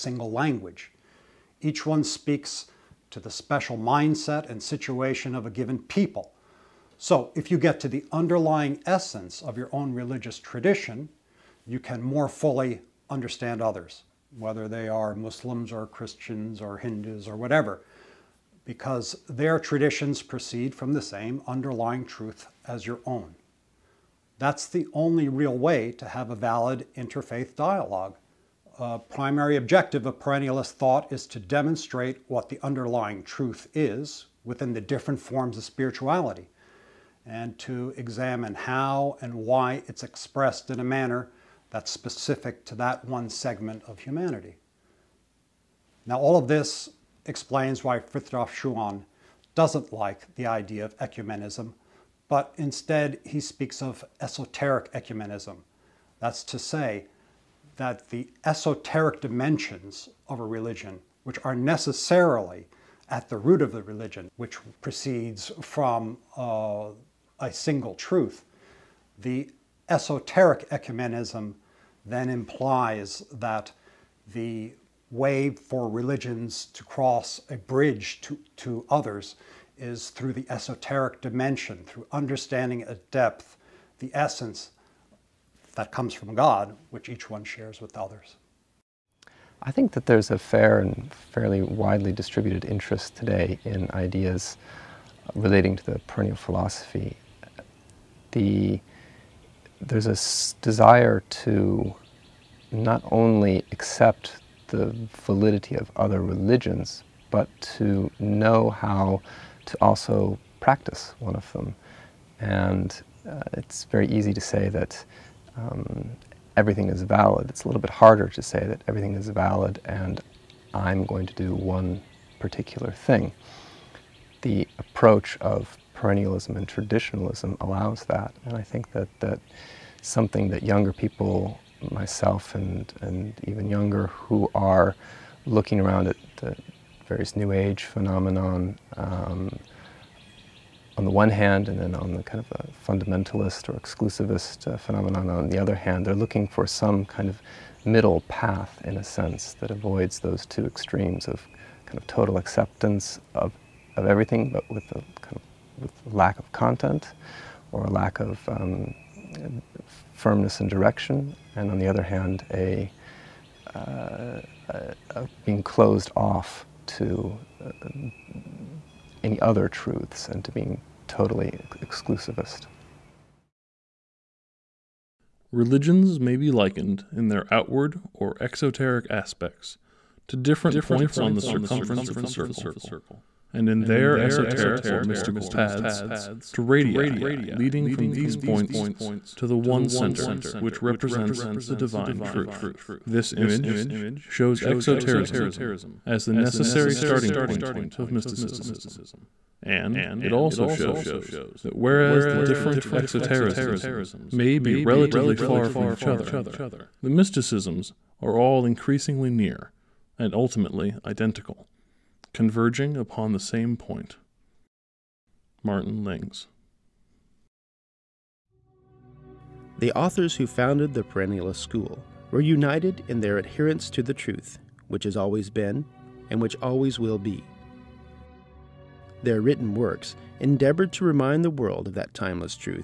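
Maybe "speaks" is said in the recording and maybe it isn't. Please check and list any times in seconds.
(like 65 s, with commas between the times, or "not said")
2 s, 53 s.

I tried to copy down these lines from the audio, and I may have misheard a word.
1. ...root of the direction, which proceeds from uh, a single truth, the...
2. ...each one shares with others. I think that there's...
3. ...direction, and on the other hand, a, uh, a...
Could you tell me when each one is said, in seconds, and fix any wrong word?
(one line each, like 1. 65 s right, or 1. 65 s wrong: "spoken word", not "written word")
1. 63 s wrong: "religion", not "direction"
2. 87 s right
3. 160 s right.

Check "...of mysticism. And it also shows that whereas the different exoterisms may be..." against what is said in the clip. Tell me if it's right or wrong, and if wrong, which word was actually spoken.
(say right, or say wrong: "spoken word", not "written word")
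right.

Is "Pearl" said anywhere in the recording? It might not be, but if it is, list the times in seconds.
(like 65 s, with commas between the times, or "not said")
not said.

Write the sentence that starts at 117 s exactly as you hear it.
It's a little bit harder to say that everything is valid and I'm going to do one particular thing.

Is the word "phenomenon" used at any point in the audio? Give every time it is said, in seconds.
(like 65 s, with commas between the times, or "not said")
137 s, 144 s.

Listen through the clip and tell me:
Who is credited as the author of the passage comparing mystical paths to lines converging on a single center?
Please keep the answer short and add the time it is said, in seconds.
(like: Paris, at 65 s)
Martin Lings, at 215 s.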